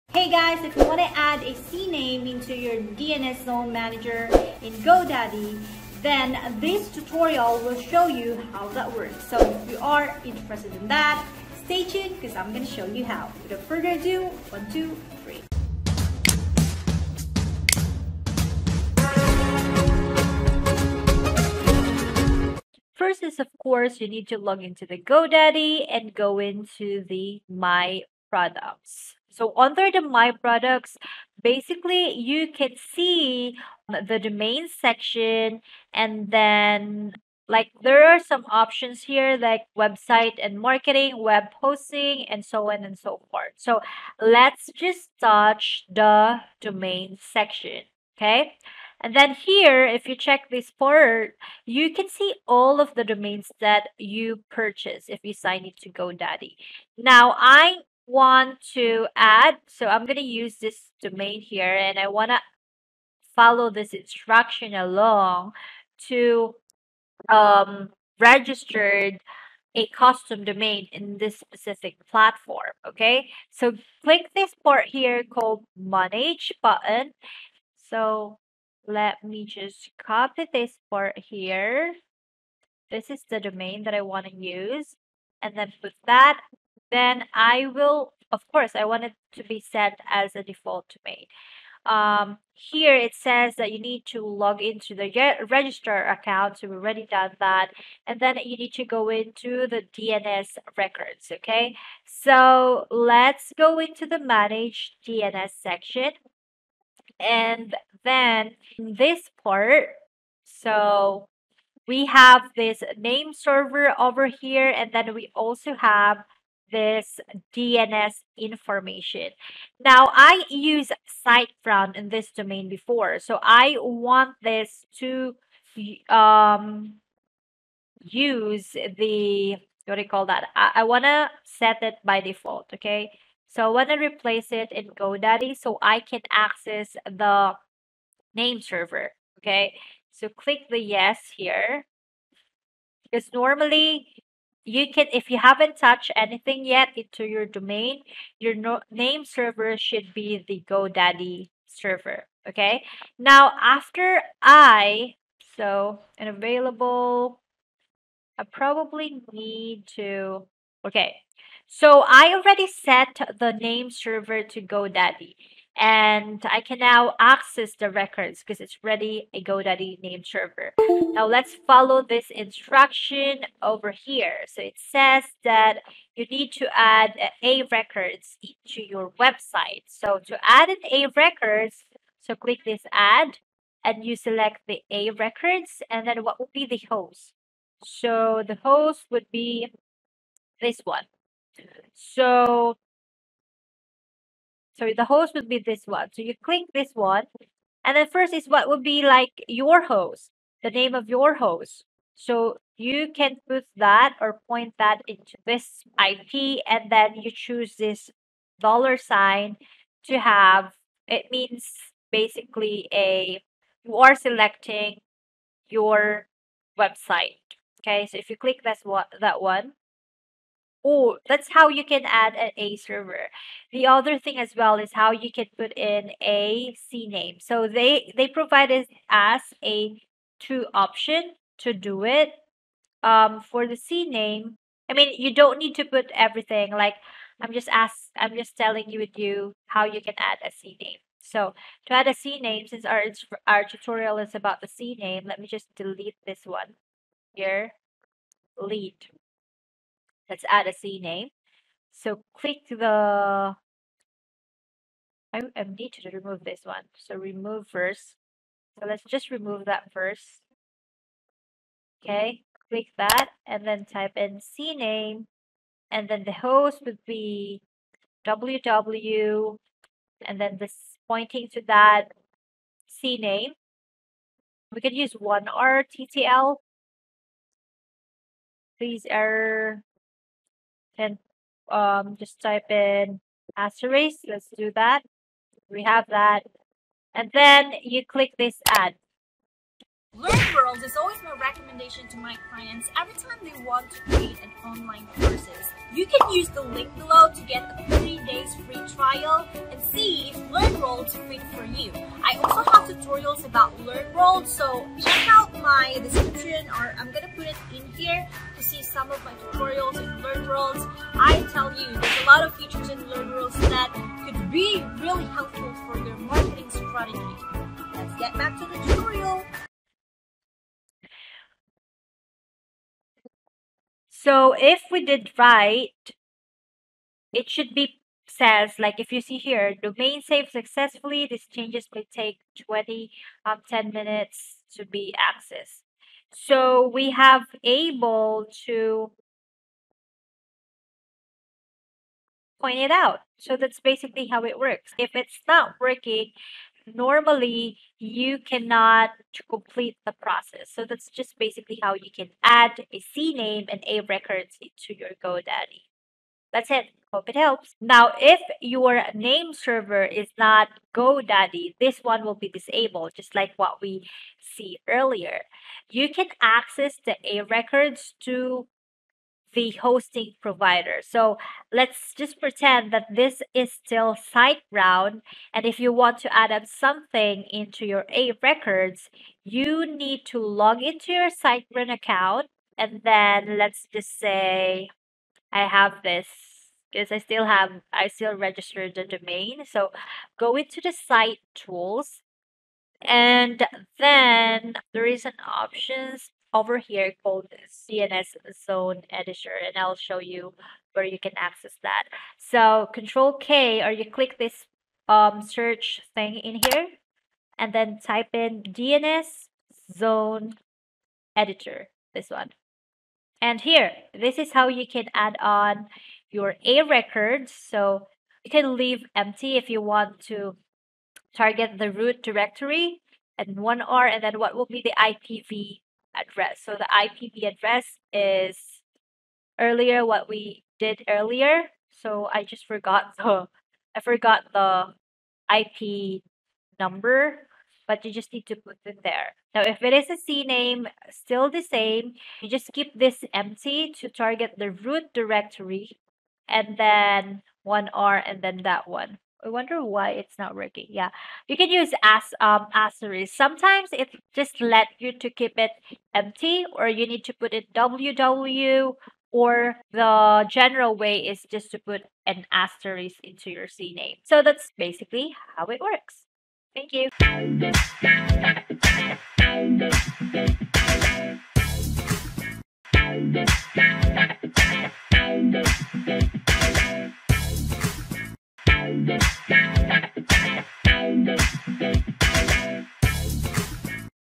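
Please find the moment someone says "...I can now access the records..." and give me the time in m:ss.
2:46.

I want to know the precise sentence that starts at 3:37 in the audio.
Okay, so if you click this one that one, Oh, that's how you can add an A server.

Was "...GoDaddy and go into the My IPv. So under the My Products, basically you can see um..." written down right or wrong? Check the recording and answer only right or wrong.
wrong.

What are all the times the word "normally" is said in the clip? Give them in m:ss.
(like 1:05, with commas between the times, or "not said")
2:23, 5:46.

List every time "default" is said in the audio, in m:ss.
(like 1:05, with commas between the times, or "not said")
1:30, 2:12.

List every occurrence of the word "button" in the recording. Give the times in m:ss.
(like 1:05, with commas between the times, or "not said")
1:16.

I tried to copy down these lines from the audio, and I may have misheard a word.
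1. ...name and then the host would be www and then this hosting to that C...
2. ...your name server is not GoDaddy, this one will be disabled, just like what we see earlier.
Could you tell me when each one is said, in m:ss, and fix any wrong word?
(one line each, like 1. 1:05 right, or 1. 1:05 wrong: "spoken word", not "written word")
1. 4:24 wrong: "pointing", not "hosting"
2. 5:58 right.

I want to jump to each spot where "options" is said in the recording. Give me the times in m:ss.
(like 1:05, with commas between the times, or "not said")
0:38, 3:50, 6:35.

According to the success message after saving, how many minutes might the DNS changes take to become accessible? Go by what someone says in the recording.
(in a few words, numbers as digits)
10.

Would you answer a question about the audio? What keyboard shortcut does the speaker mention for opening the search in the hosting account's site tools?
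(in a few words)
Control K.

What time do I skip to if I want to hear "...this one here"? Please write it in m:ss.
4:06.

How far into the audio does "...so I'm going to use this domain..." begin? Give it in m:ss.
0:59.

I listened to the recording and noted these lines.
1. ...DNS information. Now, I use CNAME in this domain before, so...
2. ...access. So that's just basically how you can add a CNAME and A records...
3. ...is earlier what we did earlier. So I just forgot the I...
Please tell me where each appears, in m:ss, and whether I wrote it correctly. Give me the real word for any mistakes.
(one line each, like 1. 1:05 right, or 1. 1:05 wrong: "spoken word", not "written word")
1. 1:57 wrong: "SiteGround", not "CNAME"
2. 5:50 wrong: "process", not "access"
3. 7:08 right.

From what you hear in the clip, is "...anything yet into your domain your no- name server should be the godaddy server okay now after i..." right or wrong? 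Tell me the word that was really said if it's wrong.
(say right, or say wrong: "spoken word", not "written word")
right.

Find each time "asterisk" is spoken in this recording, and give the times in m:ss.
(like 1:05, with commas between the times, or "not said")
4:43, 7:32, 7:42.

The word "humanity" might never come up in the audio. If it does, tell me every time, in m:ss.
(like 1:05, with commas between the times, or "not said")
not said.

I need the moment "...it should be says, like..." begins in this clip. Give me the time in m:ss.
5:27.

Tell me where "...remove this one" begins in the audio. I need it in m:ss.
4:16.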